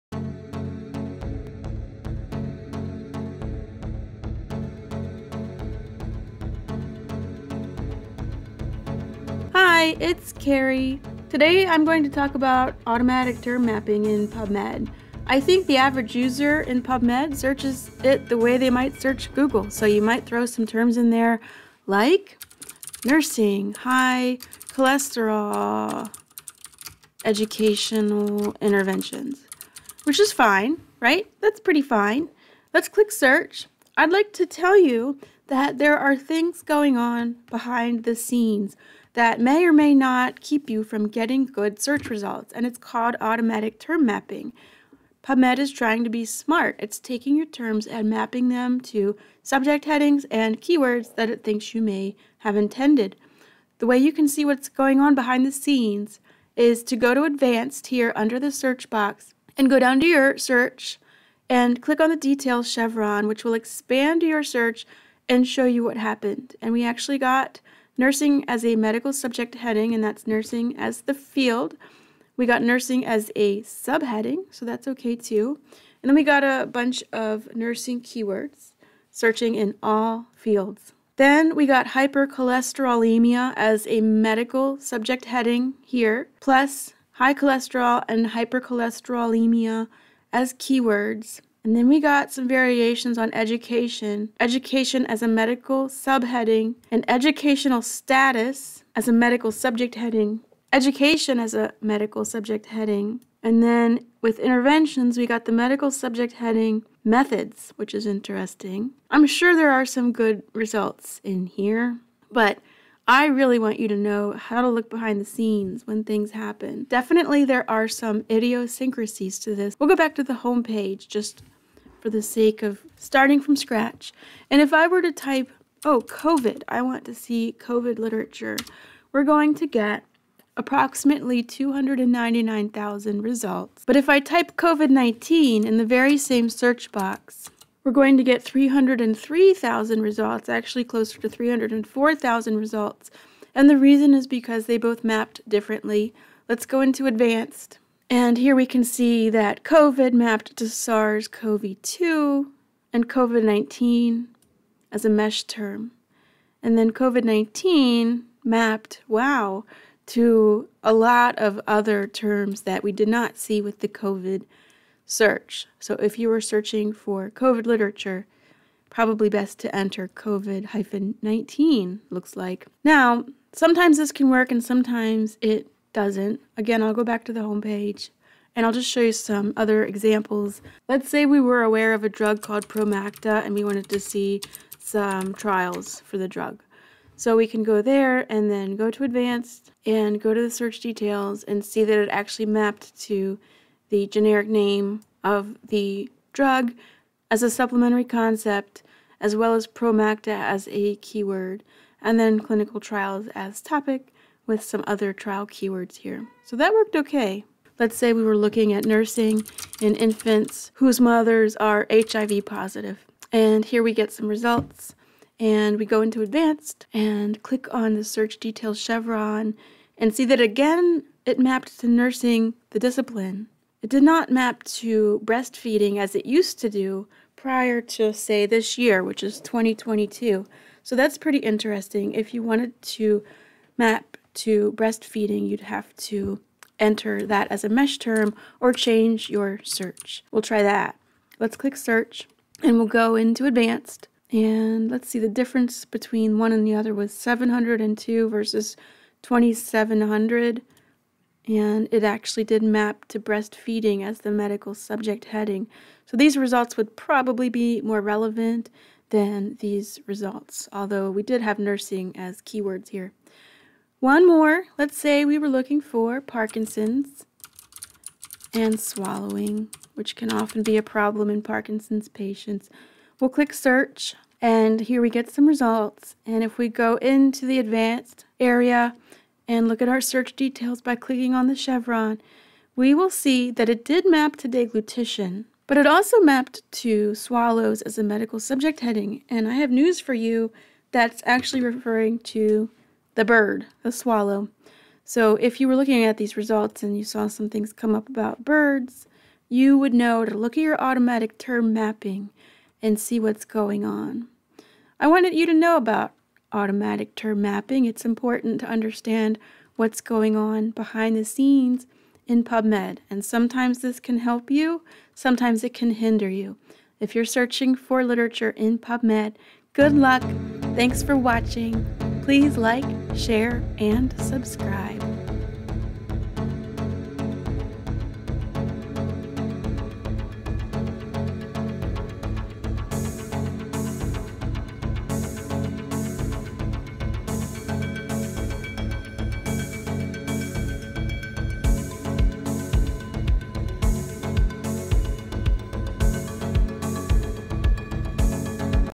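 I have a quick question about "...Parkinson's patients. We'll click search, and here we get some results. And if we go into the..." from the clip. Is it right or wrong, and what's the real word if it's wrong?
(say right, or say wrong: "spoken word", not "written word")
right.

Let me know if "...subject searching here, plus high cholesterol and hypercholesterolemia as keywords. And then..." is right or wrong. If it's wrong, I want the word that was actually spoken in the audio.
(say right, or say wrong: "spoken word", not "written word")
wrong: "heading", not "searching".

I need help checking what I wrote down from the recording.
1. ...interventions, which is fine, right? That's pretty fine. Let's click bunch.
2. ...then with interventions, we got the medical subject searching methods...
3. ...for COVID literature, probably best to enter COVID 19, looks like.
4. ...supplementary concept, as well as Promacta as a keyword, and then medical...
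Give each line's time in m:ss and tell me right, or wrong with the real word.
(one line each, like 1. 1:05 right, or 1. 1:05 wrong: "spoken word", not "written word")
1. 0:28 wrong: "search", not "bunch"
2. 1:43 wrong: "heading", not "searching"
3. 2:46 right
4. 3:17 wrong: "clinical", not "medical".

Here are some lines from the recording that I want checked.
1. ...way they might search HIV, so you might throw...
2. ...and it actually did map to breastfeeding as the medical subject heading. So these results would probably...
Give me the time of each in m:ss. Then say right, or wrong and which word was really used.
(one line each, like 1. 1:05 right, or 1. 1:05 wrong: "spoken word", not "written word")
1. 0:18 wrong: "Google", not "HIV"
2. 4:11 right.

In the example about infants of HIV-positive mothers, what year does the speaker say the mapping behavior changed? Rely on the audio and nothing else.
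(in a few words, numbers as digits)
2022.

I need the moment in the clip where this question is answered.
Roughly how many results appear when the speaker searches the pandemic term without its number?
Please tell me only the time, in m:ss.
2:11.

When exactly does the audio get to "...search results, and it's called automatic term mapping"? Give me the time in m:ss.
0:41.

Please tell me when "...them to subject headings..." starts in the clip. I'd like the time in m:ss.
0:48.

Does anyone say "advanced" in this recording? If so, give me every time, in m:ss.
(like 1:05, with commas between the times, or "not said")
0:57, 2:27, 3:09, 3:36, 4:03, 4:37.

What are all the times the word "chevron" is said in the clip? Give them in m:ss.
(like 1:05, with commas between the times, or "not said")
1:02, 3:38, 4:41.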